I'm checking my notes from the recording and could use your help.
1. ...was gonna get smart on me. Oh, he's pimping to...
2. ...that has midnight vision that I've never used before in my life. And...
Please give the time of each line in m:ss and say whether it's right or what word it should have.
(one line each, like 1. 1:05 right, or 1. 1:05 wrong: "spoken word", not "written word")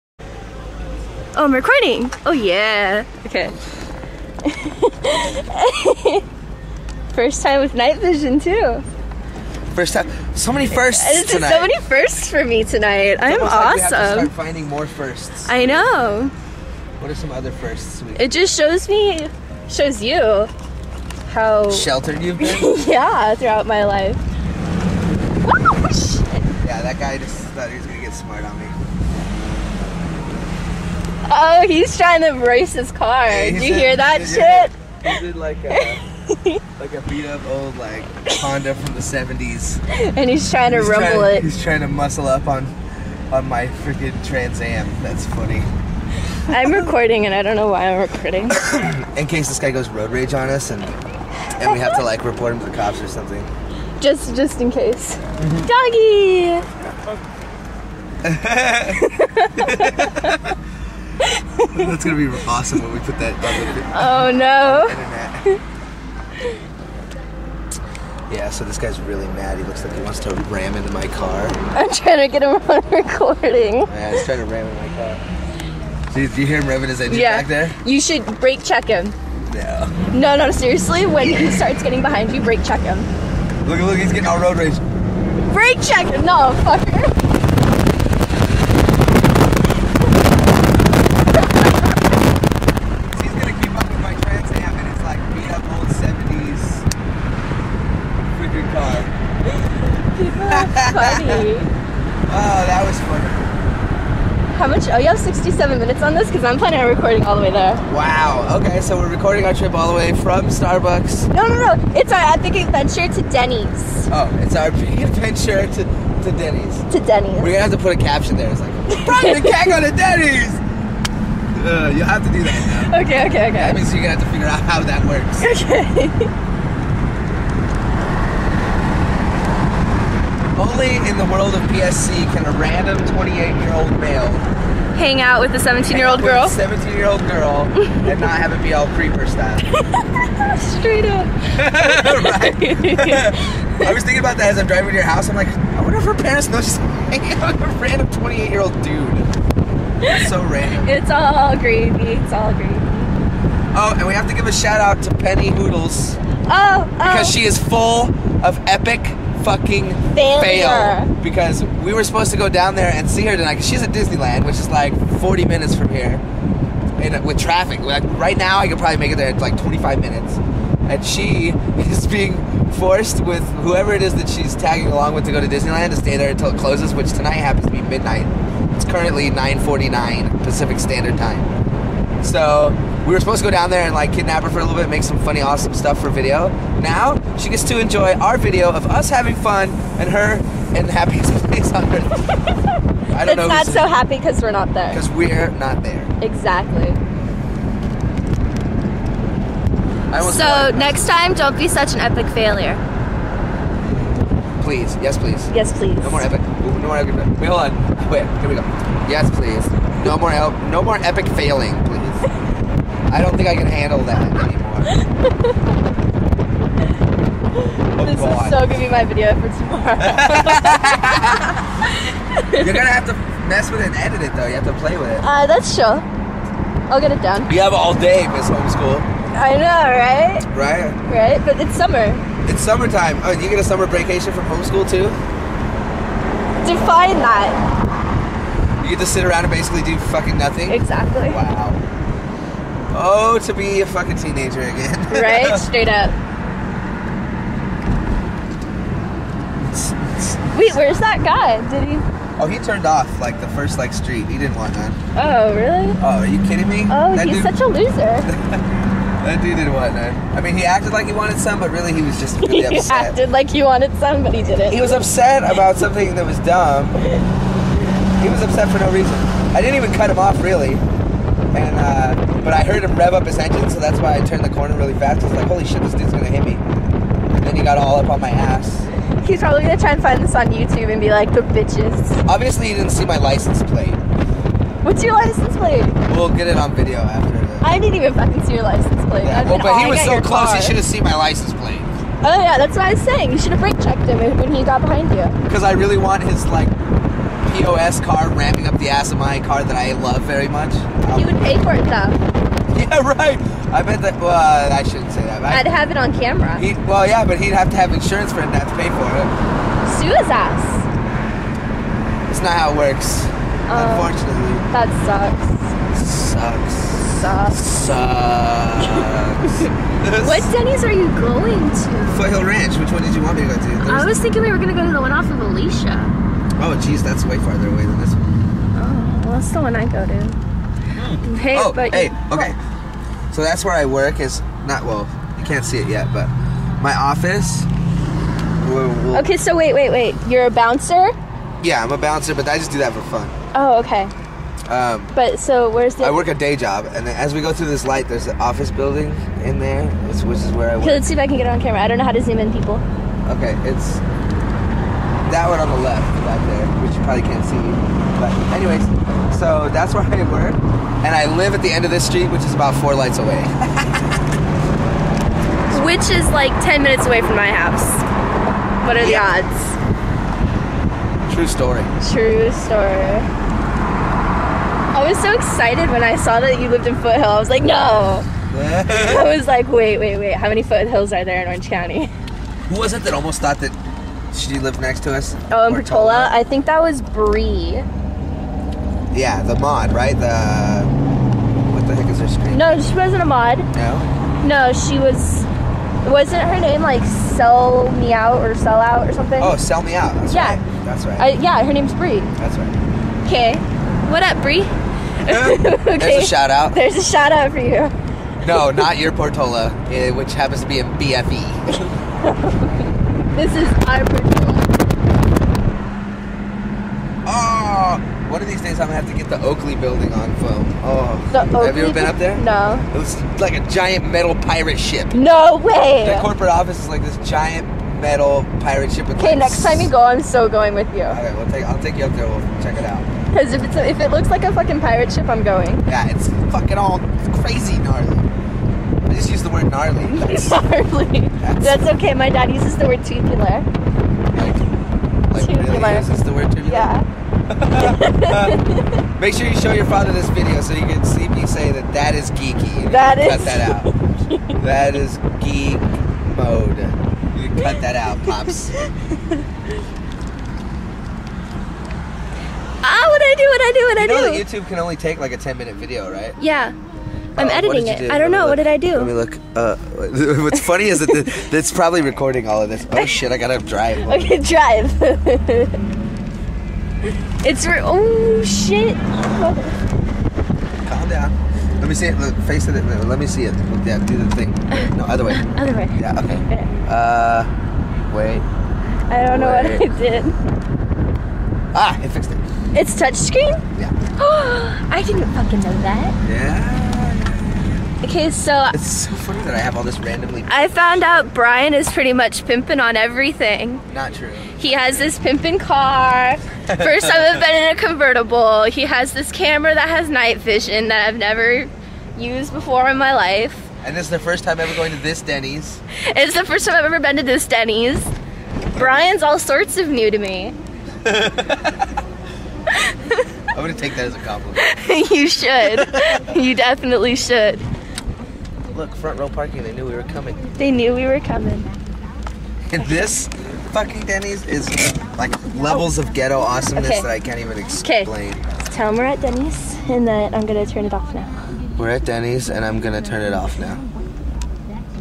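1. 0:27 wrong: "trying", not "pimping"
2. 8:29 wrong: "night", not "midnight".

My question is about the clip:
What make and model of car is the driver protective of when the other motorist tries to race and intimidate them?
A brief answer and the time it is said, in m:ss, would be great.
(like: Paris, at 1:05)
Trans Am, at 0:44.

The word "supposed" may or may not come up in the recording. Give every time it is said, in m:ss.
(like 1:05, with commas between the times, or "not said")
2:42, 3:03.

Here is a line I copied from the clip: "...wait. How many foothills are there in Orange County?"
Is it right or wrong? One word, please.
right.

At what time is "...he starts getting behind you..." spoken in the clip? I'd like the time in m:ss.
1:21.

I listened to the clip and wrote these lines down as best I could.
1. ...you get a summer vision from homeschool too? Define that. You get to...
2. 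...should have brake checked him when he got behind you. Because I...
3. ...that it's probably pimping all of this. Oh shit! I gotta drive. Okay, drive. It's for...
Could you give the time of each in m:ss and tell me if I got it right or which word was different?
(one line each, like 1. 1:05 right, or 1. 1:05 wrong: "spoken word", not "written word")
1. 3:53 wrong: "vacation", not "vision"
2. 4:53 right
3. 7:50 wrong: "recording", not "pimping".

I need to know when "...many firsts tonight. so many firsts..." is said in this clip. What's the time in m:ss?
0:10.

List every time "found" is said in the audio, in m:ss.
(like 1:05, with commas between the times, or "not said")
8:20.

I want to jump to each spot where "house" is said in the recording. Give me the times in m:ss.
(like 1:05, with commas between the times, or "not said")
2:25, 6:07.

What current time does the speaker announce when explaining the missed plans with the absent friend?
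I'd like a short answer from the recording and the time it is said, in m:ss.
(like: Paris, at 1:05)
9:49, at 2:59.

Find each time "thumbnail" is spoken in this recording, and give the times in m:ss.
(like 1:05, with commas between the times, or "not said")
not said.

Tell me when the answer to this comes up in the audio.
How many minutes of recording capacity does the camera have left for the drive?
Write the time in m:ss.
1:45.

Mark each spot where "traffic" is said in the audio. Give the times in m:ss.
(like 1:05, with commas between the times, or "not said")
2:47.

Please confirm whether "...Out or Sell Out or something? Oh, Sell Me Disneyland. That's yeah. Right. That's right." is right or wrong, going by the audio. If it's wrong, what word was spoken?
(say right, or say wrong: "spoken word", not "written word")
wrong: "Out", not "Disneyland".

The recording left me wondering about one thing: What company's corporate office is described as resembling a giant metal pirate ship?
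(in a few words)
Oakley.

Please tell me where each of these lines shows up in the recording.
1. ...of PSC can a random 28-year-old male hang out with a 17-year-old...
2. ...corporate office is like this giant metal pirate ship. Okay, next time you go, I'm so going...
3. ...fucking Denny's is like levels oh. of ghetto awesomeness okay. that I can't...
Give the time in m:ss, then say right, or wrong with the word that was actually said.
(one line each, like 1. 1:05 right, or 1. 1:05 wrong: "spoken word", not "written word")
1. 2:11 right
2. 7:06 right
3. 8:53 right.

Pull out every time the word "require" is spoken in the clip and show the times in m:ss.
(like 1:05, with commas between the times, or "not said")
not said.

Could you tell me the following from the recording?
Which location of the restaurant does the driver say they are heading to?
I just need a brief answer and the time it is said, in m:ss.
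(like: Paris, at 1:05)
Foothill Ranch, at 5:22.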